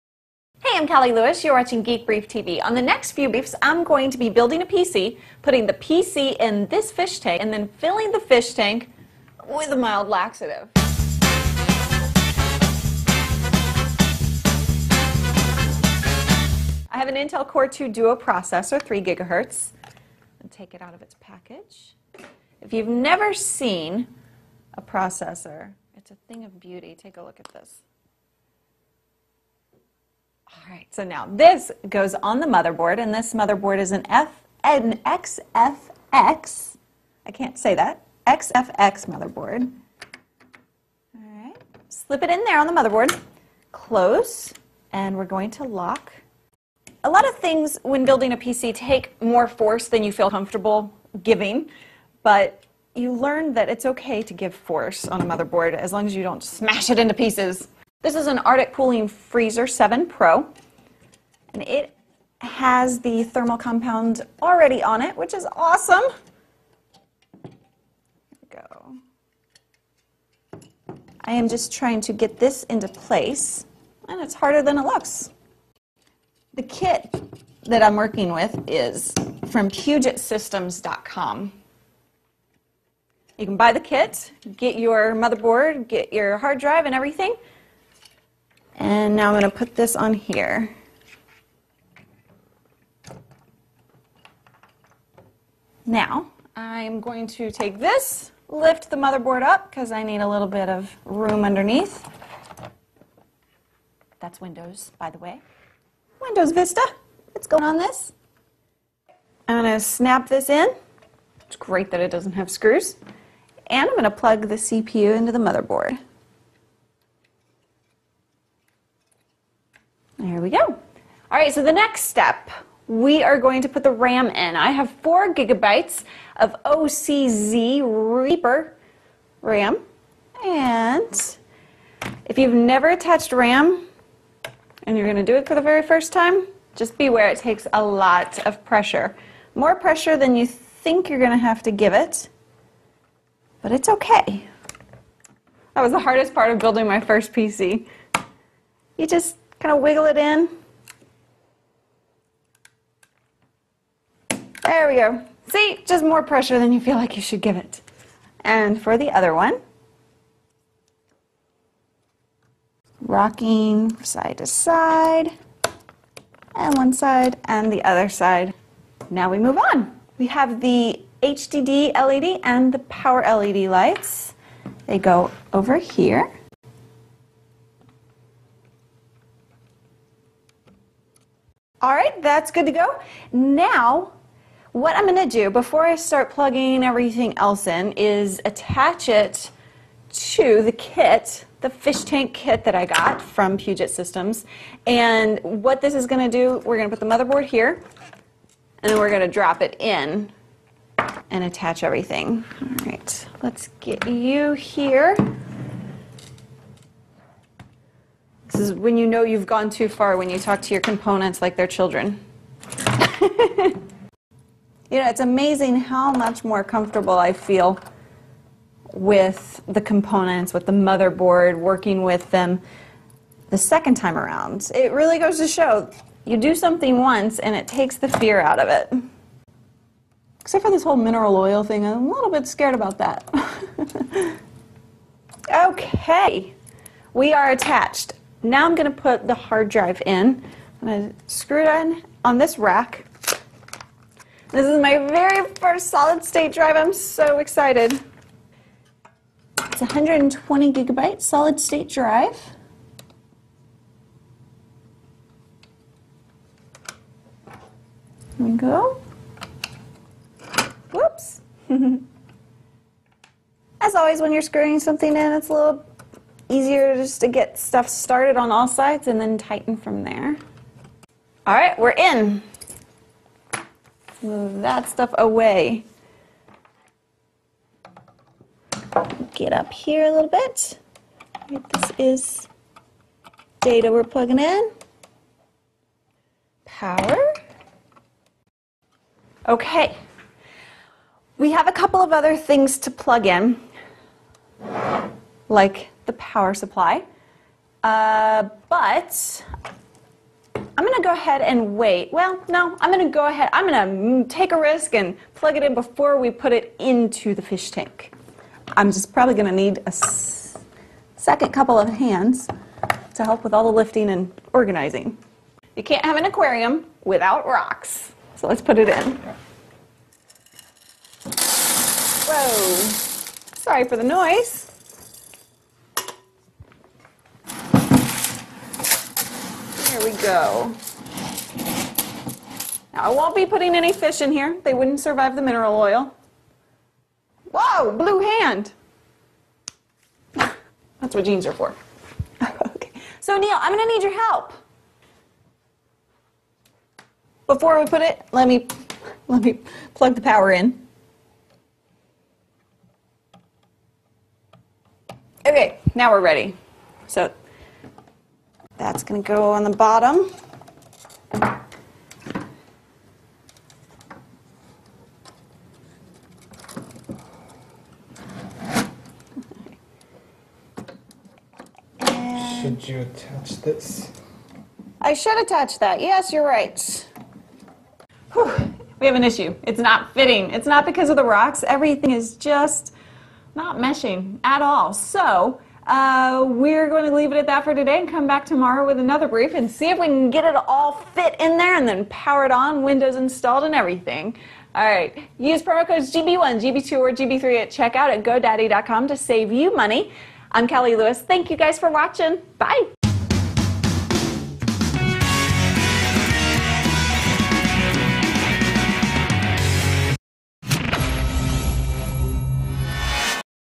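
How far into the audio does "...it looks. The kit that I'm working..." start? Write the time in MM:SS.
01:14.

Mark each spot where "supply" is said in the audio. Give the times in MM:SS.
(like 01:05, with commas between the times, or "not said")
04:56.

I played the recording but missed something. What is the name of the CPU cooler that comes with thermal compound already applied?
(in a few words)
Arctic Cooling Freezer 7 Pro.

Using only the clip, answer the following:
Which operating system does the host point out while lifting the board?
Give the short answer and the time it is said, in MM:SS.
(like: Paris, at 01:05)
Windows Vista, at 01:46.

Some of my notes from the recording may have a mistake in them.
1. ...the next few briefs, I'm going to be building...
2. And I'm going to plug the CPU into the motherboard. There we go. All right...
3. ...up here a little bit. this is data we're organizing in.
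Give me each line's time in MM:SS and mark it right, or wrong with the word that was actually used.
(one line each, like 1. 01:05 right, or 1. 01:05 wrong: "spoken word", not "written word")
1. 00:02 right
2. 01:53 right
3. 04:39 wrong: "plugging", not "organizing".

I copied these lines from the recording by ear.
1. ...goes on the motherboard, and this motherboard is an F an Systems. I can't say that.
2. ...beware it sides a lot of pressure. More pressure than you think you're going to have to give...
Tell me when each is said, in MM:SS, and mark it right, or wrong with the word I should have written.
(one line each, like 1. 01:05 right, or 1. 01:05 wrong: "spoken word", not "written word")
1. 00:31 wrong: "XFX", not "Systems"
2. 02:16 wrong: "takes", not "sides".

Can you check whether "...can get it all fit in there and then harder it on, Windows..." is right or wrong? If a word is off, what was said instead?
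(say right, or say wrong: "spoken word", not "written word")
wrong: "power", not "harder".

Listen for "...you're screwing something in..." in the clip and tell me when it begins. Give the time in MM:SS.
04:24.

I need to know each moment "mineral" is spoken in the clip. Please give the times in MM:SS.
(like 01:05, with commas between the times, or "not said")
03:50, 05:35.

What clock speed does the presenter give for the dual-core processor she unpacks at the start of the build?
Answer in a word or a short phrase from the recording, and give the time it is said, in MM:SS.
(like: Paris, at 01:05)
3 gigahertz, at 00:18.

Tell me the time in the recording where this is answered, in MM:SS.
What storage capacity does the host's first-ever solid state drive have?
04:09.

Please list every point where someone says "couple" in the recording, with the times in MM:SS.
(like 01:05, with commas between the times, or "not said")
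04:51, 05:11.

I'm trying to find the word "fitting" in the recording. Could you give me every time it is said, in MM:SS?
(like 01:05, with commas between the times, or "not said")
06:20.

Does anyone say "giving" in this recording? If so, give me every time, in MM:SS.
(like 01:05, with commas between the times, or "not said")
00:51.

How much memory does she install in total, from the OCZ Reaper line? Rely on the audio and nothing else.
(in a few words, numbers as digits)
4 gigabytes.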